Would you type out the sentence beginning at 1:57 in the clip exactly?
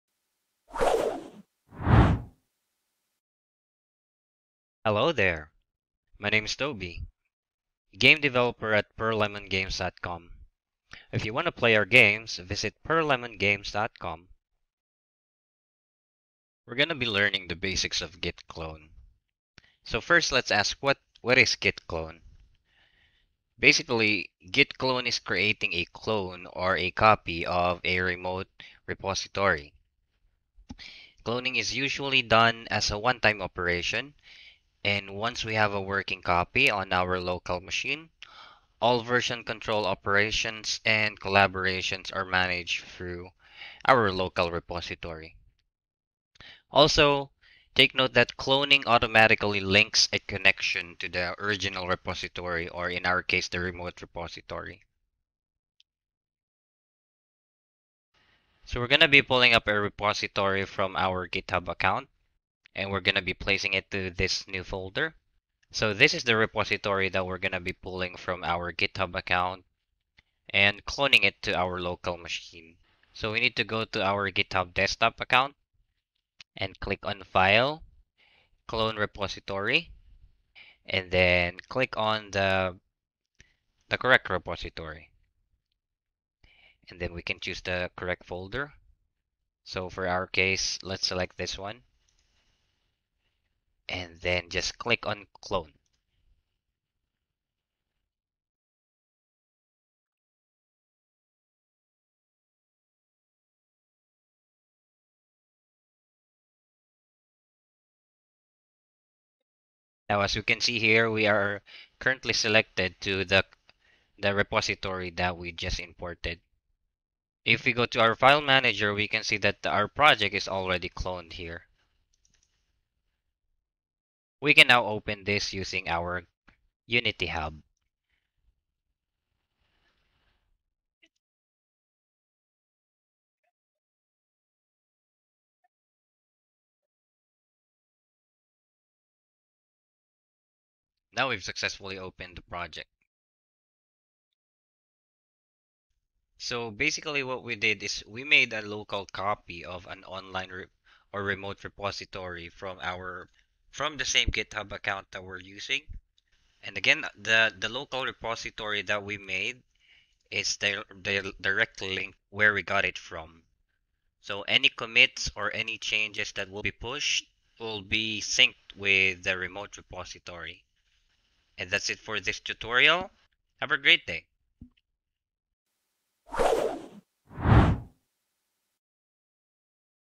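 If we go to our file manager, we can see that our project is already cloned here.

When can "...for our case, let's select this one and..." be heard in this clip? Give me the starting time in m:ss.
1:29.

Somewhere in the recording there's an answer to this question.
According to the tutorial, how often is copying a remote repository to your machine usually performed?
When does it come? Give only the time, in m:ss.
0:32.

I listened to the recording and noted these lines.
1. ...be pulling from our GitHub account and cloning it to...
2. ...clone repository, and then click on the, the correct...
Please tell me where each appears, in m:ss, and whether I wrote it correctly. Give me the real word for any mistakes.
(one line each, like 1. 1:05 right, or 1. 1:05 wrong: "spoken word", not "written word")
1. 1:07 right
2. 1:18 right.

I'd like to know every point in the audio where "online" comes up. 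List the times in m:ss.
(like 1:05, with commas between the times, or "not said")
2:30.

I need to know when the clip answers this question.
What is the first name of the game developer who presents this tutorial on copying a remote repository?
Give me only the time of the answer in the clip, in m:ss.
0:06.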